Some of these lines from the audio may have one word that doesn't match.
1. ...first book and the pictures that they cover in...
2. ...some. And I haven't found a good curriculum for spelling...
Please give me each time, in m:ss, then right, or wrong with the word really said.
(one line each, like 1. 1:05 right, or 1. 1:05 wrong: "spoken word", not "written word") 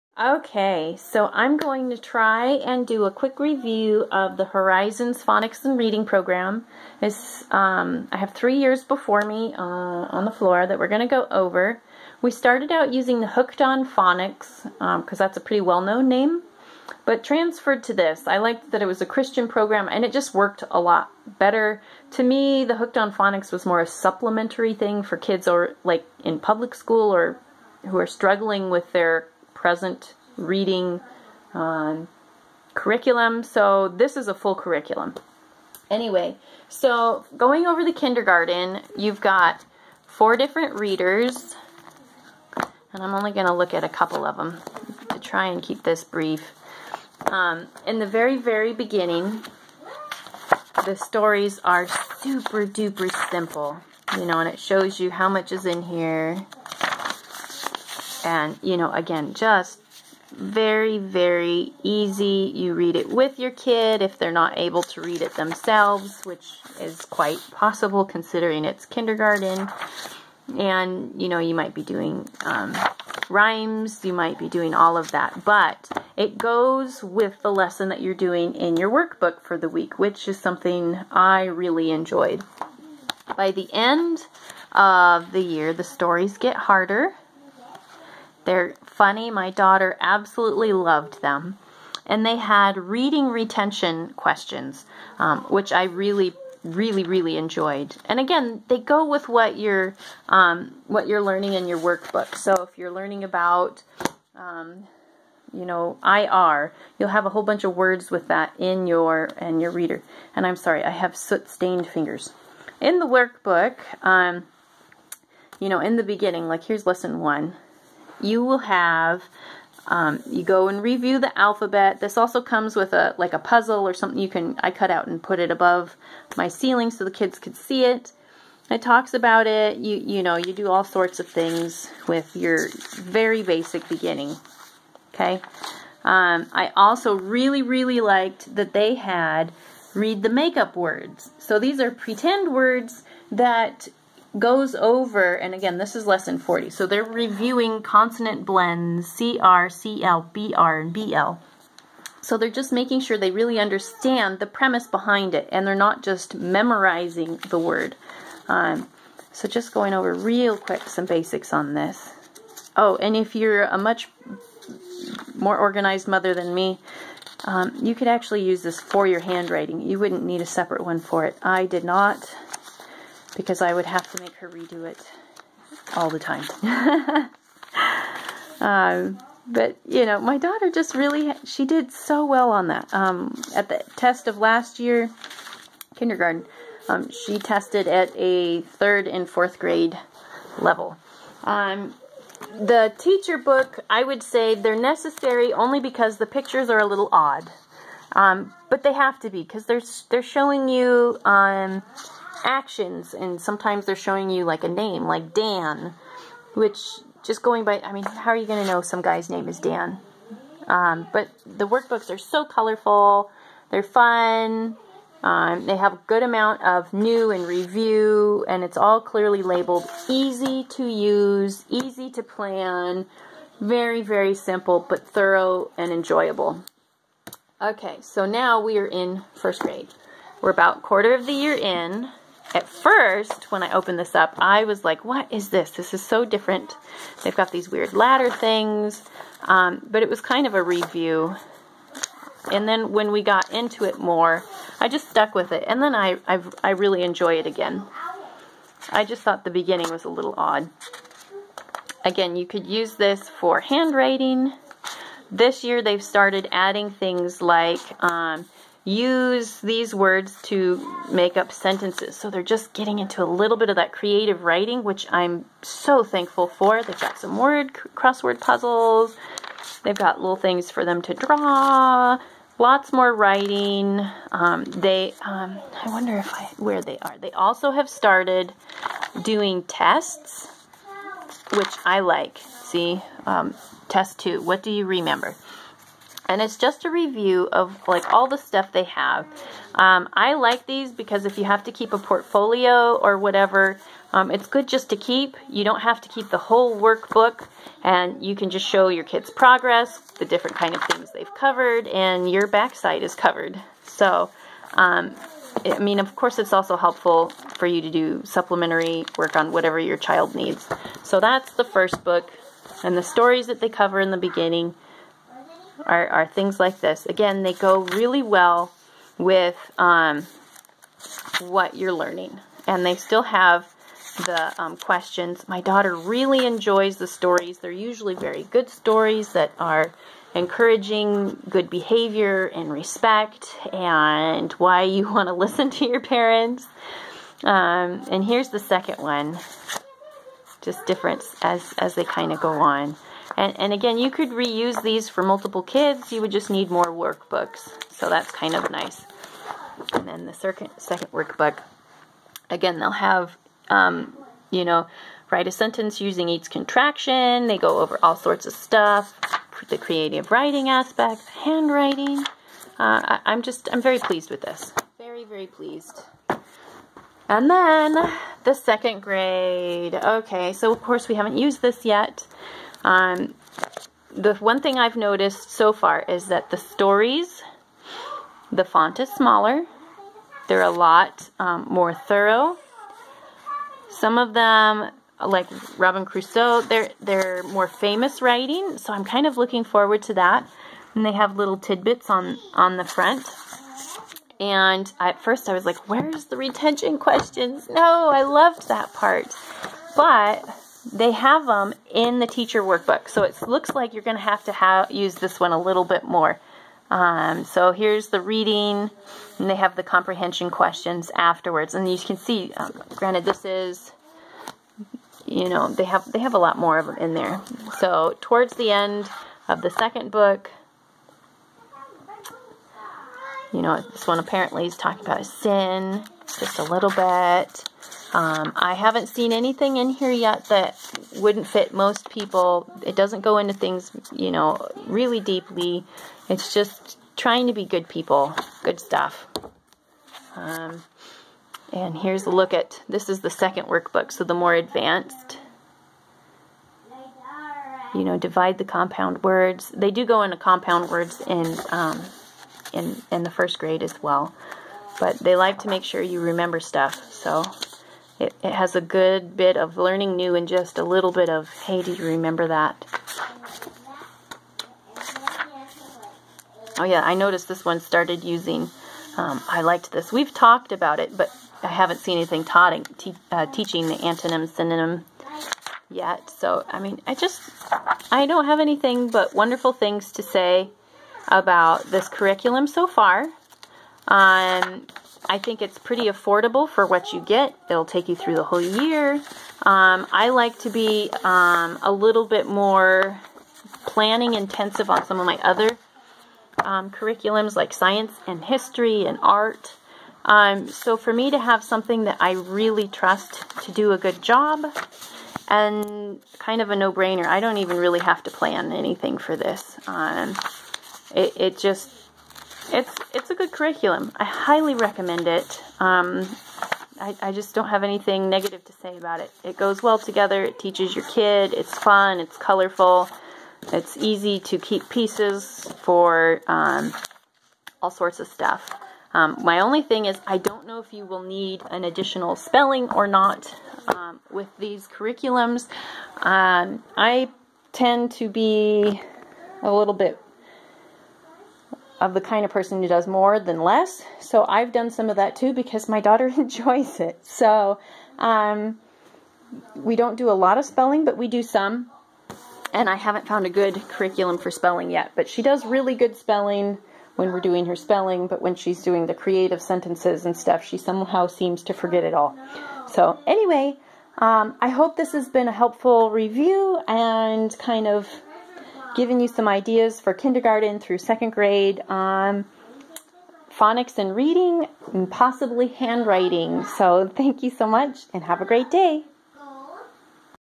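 1. 5:11 wrong: "stories", not "pictures"
2. 9:11 right.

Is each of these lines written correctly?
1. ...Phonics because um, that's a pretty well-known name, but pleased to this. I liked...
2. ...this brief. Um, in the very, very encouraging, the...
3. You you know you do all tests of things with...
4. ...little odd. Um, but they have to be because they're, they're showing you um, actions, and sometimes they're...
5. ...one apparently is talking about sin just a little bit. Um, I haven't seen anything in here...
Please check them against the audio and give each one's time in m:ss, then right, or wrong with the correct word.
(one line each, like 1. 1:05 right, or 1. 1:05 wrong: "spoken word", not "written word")
1. 0:13 wrong: "transferred", not "pleased"
2. 0:45 wrong: "beginning", not "encouraging"
3. 2:09 wrong: "sorts", not "tests"
4. 3:16 right
5. 7:04 right.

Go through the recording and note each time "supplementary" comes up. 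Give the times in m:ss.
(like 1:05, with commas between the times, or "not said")
0:23, 5:08.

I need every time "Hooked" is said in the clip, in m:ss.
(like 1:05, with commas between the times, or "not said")
0:13, 0:22.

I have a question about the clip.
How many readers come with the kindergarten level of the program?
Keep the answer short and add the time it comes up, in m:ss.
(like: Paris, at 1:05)
4, at 0:40.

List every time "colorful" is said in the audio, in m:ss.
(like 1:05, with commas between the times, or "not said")
3:32, 8:42.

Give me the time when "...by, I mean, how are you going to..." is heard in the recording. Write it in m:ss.
3:27.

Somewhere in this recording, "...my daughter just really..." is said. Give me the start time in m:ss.
3:00.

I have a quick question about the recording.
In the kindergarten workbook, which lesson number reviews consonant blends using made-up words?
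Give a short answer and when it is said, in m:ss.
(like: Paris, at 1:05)
Lesson 40, at 2:26.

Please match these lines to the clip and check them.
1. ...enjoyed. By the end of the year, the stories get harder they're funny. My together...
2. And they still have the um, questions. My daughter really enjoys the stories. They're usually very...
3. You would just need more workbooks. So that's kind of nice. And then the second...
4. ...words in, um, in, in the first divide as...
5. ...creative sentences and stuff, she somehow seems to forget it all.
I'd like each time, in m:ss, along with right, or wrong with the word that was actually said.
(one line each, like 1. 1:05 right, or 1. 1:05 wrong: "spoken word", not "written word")
1. 1:21 wrong: "daughter", not "together"
2. 5:22 right
3. 5:46 right
4. 7:30 wrong: "grade", not "divide"
5. 9:19 right.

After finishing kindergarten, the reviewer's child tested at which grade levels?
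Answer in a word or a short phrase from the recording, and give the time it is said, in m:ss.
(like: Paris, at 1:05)
Third and fourth grade, at 3:08.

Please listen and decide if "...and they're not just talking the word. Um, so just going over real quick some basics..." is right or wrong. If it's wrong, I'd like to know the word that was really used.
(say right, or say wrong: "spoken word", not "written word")
wrong: "memorizing", not "talking".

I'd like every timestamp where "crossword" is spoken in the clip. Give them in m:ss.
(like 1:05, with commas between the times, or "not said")
4:27.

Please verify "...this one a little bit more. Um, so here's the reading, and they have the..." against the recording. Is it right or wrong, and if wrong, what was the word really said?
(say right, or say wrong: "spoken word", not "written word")
right.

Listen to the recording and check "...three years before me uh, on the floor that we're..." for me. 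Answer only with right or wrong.
right.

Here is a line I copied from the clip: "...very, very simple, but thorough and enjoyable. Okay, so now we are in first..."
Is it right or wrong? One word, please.
right.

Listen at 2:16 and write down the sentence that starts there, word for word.
Um, I also really really liked that they had read the makeup words.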